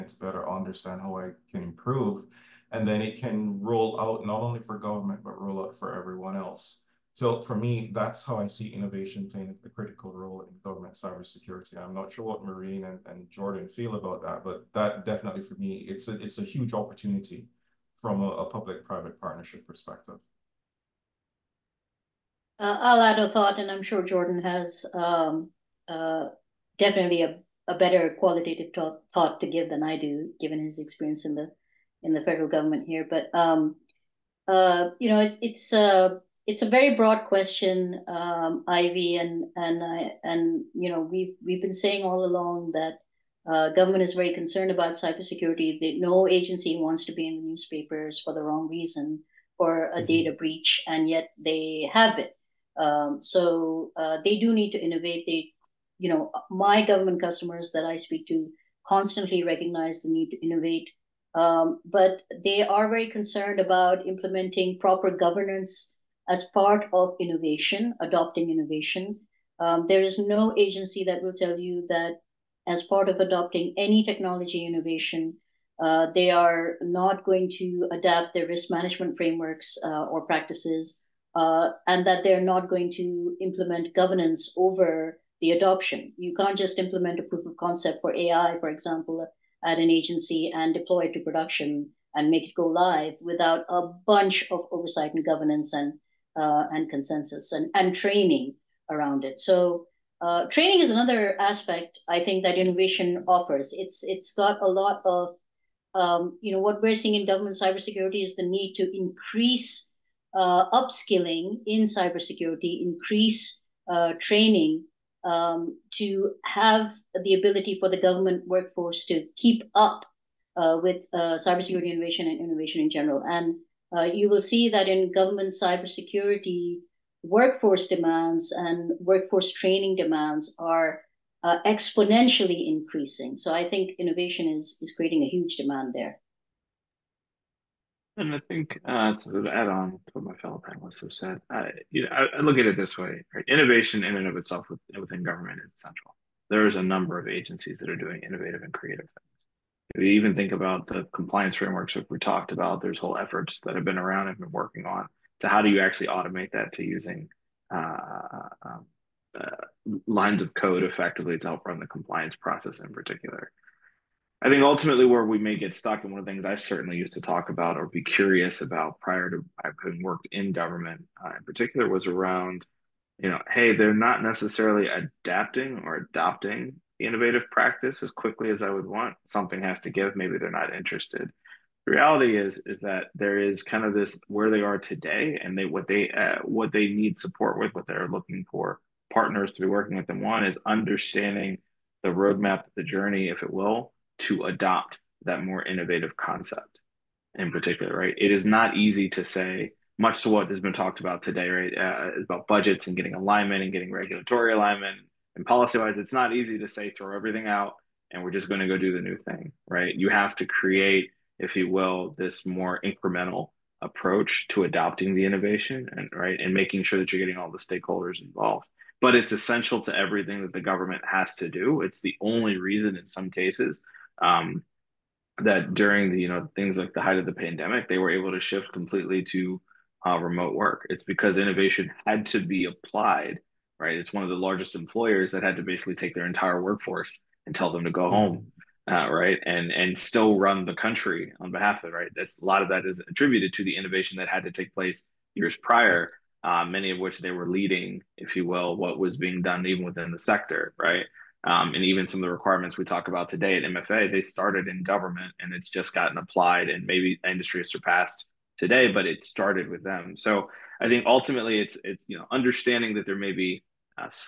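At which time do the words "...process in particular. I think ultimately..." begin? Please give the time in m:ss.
2:42.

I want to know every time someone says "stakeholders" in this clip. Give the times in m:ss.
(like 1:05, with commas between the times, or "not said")
3:37.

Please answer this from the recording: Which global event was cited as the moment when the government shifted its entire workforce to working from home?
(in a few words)
The pandemic.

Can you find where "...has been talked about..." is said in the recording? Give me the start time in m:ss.
3:20.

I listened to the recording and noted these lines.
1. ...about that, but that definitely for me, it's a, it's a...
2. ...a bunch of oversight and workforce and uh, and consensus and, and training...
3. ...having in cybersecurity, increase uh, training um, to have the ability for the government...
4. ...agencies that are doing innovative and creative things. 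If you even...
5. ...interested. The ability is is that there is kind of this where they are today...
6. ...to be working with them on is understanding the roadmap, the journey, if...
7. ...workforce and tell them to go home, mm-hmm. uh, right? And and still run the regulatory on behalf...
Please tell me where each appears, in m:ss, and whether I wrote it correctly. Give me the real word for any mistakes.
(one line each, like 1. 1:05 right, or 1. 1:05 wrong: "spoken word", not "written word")
1. 0:13 right
2. 1:33 wrong: "governance", not "workforce"
3. 1:50 wrong: "upskilling", not "having"
4. 2:27 right
5. 3:00 wrong: "reality", not "ability"
6. 3:09 right
7. 3:56 wrong: "country", not "regulatory".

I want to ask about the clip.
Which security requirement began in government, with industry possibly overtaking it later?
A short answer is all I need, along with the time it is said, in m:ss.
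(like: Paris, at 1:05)
MFA, at 4:13.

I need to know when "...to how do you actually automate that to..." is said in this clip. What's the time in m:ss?
2:35.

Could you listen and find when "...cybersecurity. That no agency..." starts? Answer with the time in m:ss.
0:44.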